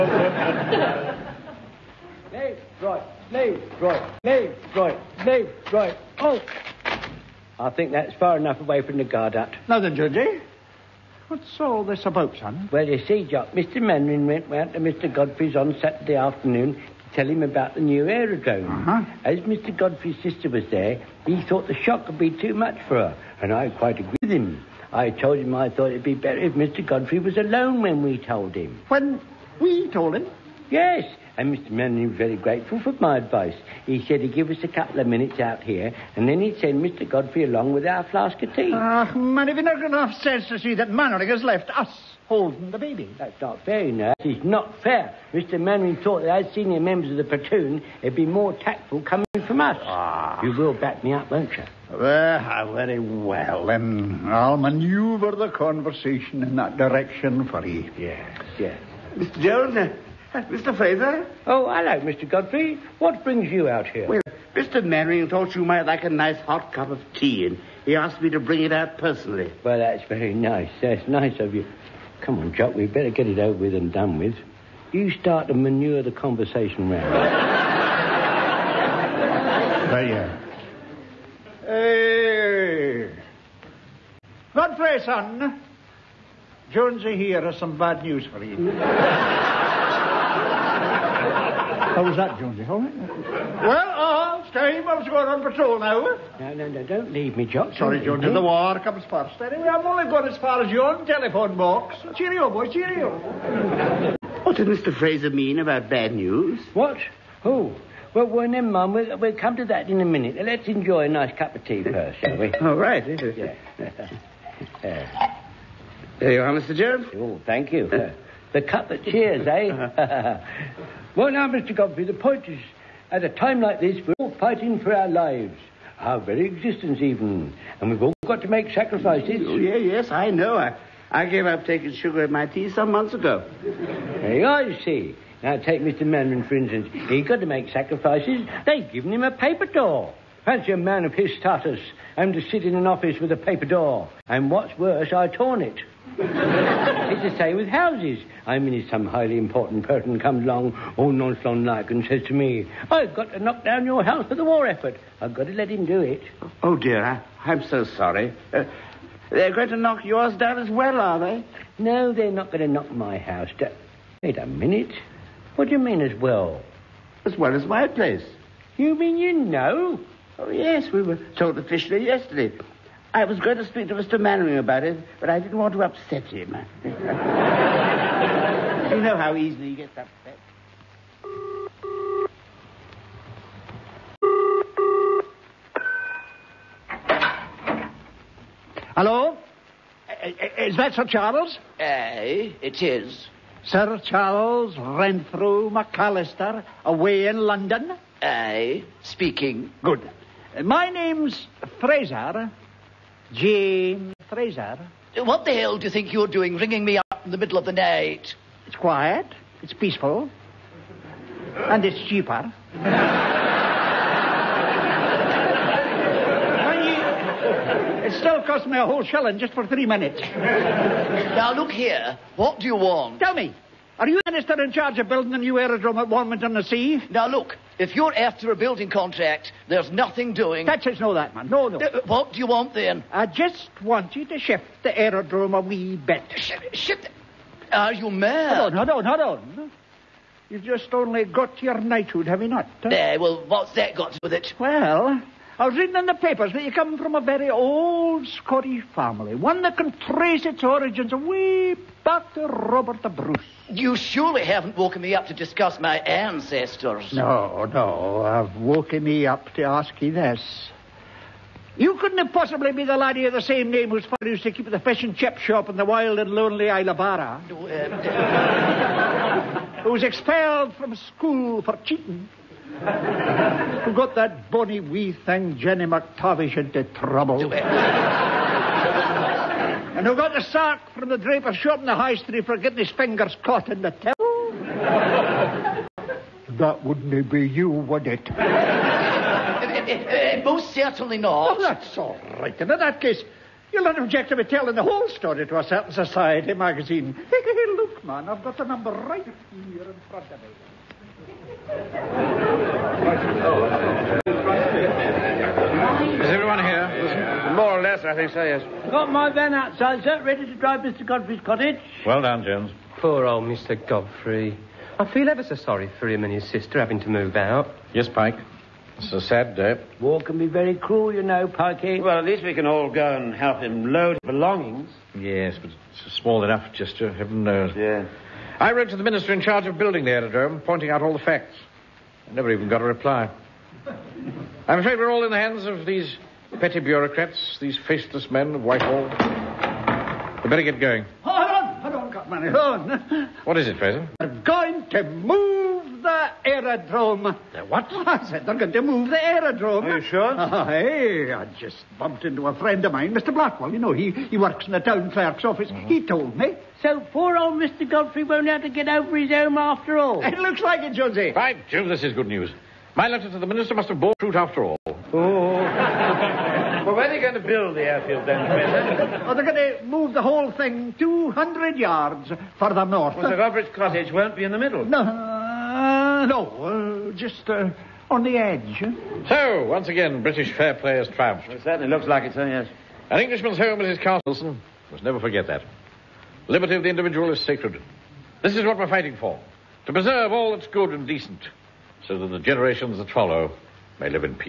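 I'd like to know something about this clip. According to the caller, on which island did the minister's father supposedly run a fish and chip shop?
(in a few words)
Isle of Barra.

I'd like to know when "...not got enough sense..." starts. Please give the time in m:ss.
0:39.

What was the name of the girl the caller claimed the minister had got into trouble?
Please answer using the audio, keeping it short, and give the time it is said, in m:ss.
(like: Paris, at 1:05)
Jenny McTavish, at 4:35.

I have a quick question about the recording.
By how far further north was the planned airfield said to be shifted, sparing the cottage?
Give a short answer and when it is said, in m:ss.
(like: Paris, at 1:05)
200 yards, at 6:10.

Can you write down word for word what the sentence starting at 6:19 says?
So, once again, British fair play has triumphed.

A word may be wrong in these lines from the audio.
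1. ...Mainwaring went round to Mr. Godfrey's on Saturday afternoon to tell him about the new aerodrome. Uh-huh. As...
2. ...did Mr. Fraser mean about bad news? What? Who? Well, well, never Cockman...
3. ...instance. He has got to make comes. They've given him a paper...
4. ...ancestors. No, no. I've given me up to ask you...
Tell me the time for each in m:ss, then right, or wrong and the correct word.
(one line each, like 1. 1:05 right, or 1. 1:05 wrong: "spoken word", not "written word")
1. 0:13 right
2. 1:44 wrong: "Mum", not "Cockman"
3. 2:16 wrong: "sacrifices", not "comes"
4. 4:15 wrong: "woken", not "given".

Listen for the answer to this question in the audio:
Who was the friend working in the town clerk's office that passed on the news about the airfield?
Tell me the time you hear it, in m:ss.
5:53.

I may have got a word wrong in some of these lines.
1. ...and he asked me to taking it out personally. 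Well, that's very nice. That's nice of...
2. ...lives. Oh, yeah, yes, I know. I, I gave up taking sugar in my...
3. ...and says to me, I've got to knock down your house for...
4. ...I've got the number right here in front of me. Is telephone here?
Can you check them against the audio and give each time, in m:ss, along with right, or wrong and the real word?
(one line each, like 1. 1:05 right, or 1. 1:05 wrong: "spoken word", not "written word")
1. 1:07 wrong: "bring", not "taking"
2. 2:08 wrong: "sacrifices", not "lives"
3. 2:31 right
4. 4:58 wrong: "everyone", not "telephone".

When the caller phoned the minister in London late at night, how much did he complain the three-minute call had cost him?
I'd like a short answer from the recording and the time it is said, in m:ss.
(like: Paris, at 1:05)
1 shilling, at 3:39.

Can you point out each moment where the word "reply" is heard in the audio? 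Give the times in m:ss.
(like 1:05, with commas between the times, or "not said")
5:32.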